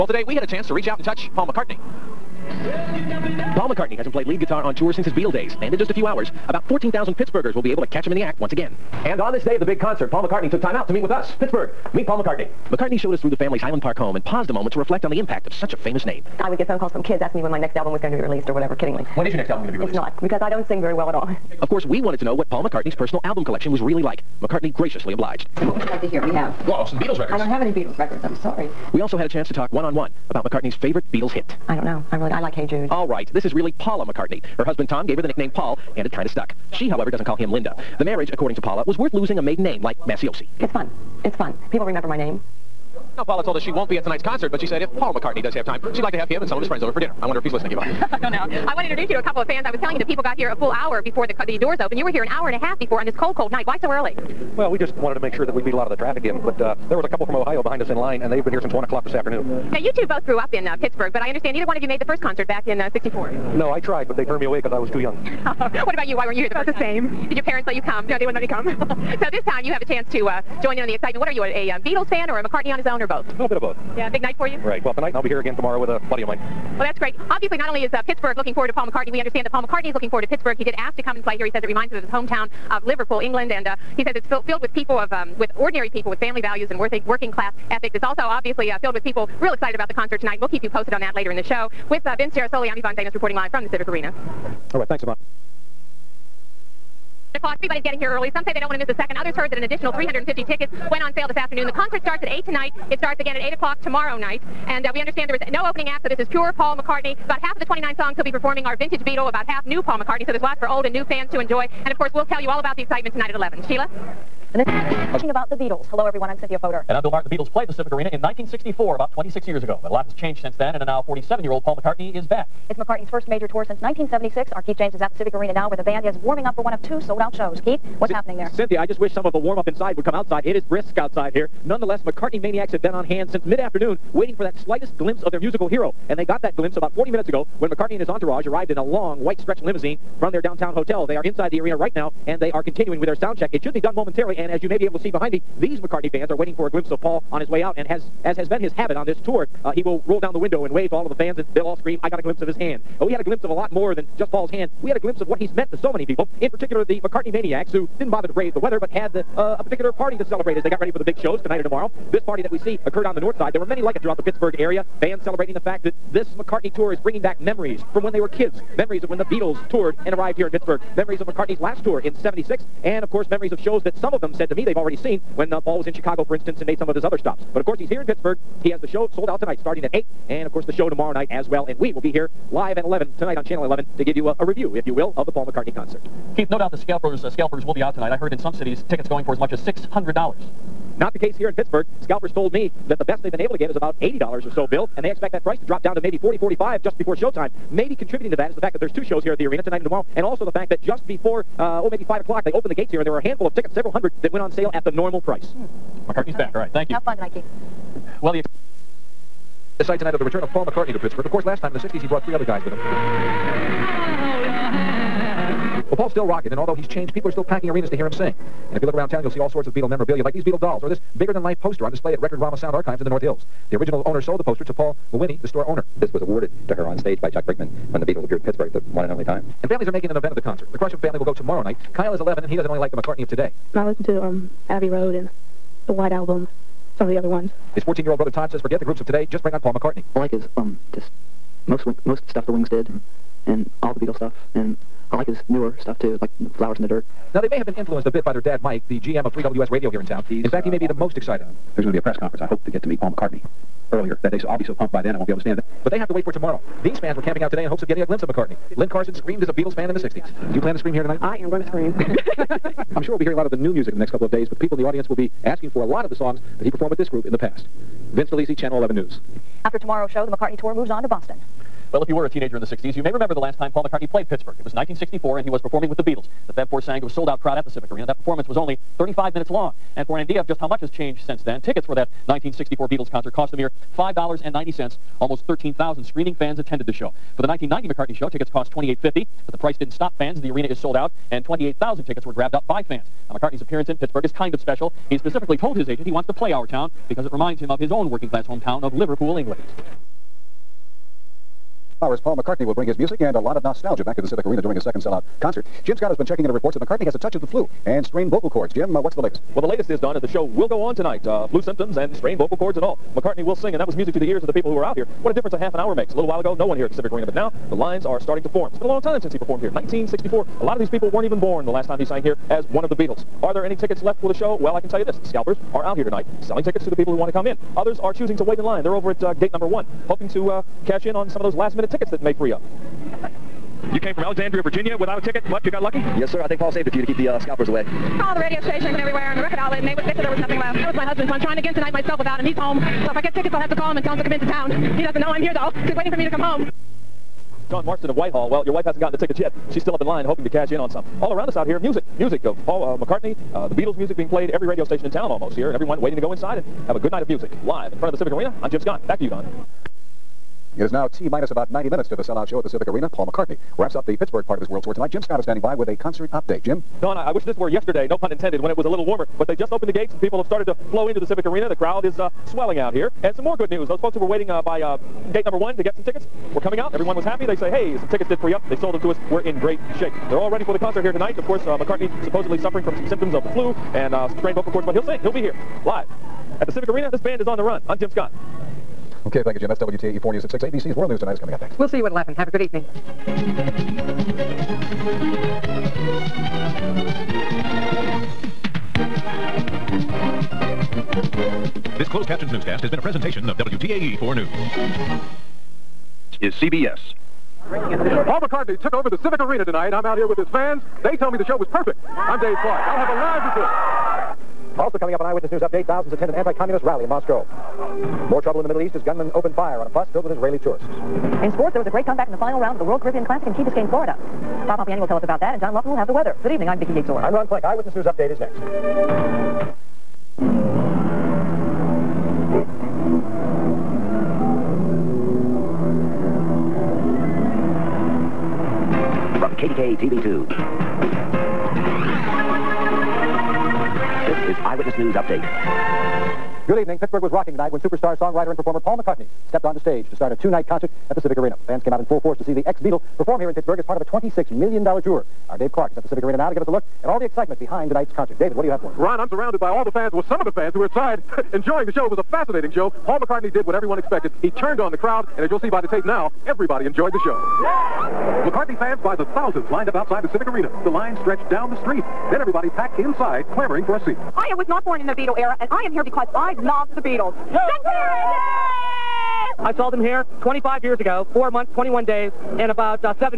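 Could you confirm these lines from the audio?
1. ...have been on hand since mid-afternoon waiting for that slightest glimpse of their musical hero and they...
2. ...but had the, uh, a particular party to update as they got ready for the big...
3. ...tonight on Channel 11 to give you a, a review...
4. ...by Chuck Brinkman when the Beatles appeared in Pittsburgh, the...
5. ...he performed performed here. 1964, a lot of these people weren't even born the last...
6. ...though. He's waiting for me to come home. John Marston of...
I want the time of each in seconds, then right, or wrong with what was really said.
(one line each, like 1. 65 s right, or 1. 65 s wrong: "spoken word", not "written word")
1. 132 s right
2. 158 s wrong: "celebrate", not "update"
3. 183 s right
4. 227 s right
5. 319 s right
6. 345 s right.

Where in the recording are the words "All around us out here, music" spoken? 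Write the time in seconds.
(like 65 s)
351 s.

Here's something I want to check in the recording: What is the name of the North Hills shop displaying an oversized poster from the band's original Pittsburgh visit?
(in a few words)
Record Rama.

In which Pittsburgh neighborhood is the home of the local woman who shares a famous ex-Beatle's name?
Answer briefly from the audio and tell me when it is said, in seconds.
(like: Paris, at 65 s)
Highland Park, at 13 s.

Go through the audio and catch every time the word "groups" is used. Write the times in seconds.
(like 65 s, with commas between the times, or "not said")
238 s, 267 s.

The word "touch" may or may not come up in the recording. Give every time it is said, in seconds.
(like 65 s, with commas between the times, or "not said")
1 s, 307 s.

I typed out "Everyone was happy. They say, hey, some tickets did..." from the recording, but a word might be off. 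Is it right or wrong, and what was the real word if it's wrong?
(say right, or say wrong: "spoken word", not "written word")
right.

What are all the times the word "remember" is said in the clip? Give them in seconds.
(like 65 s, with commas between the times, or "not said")
41 s, 273 s.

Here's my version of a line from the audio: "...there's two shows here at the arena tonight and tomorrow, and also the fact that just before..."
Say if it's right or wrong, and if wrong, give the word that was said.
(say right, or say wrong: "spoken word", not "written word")
right.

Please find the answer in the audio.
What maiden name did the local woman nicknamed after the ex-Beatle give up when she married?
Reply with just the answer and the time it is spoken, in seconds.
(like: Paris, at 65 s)
Maciosi, at 40 s.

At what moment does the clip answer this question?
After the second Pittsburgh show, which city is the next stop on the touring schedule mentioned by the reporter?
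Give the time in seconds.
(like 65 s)
271 s.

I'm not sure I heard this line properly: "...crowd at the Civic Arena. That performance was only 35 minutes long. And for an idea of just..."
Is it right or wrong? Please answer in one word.
right.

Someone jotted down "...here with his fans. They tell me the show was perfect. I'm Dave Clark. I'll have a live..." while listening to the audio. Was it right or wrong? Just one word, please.
right.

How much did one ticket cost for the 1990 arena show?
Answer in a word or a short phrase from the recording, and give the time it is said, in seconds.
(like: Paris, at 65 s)
$28.50, at 288 s.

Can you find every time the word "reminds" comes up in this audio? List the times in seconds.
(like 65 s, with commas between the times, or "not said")
81 s, 297 s.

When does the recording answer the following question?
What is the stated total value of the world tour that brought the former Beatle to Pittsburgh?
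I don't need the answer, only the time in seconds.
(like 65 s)
454 s.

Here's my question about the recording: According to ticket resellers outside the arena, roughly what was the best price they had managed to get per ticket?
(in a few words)
$80.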